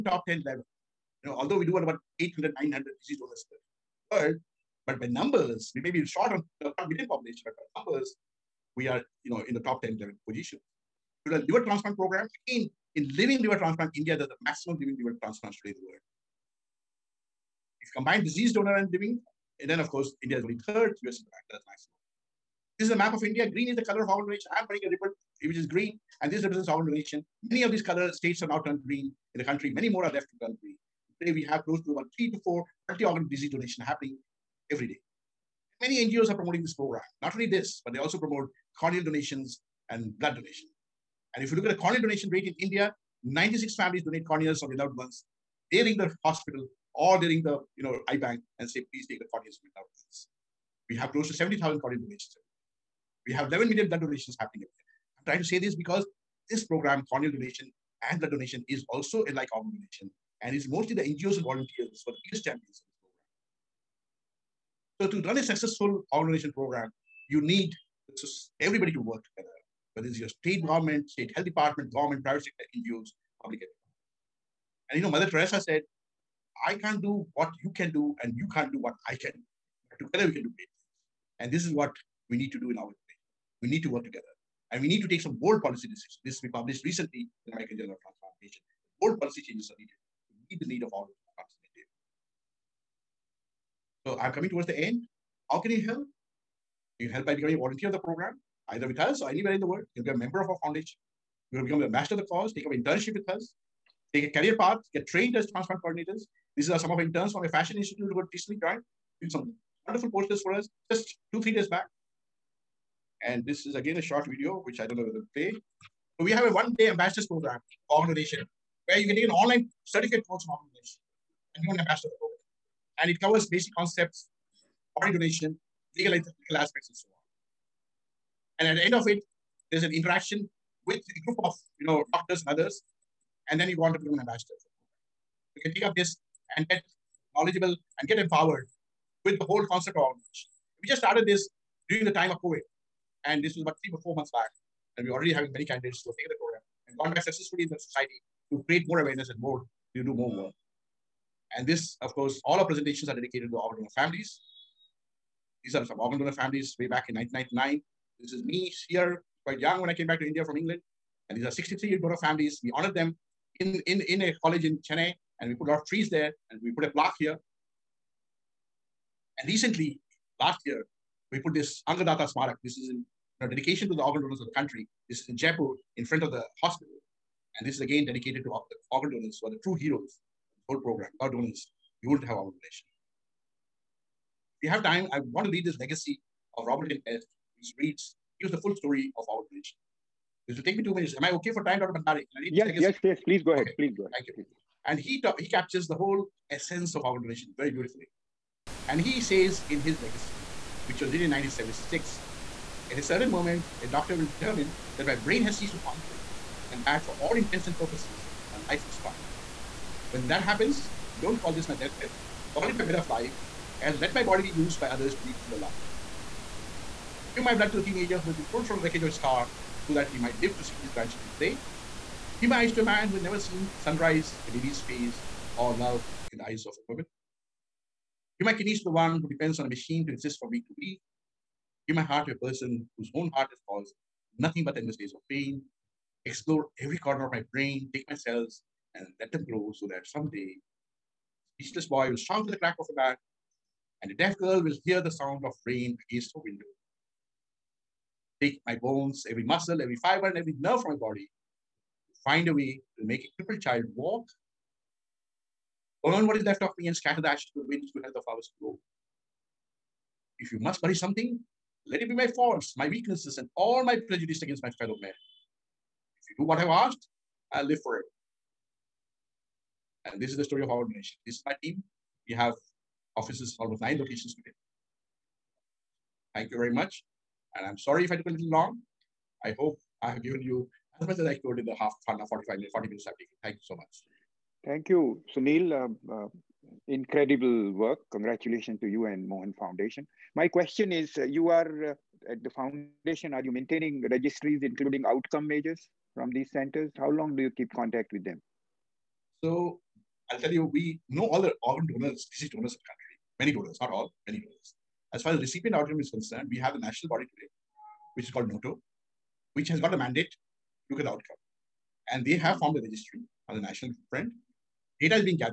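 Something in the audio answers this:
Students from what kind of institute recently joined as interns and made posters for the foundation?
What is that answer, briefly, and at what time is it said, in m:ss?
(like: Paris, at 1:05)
fashion institute, at 1:47.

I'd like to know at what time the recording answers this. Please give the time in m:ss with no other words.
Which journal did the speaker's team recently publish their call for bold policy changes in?
1:27.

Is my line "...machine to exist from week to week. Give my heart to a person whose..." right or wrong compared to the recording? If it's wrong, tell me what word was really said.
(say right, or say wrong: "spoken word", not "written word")
right.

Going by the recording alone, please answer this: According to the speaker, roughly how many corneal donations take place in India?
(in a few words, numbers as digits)
70,000.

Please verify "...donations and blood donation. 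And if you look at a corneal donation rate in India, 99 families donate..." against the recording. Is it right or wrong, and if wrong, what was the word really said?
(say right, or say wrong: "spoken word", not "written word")
wrong: "96", not "99".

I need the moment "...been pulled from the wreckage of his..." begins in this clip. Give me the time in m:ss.
3:38.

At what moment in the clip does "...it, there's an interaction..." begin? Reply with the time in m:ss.
2:09.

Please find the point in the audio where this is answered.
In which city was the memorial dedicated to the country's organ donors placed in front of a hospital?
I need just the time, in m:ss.
2:55.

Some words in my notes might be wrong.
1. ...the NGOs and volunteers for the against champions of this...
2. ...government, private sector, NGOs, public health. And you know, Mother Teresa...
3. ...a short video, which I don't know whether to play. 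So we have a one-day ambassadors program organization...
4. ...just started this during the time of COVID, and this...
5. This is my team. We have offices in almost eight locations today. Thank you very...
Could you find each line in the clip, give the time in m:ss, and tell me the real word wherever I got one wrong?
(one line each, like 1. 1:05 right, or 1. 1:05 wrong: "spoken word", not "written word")
1. 1:00 wrong: "biggest", not "against"
2. 1:11 right
3. 1:53 right
4. 2:20 right
5. 4:31 wrong: "nine", not "eight".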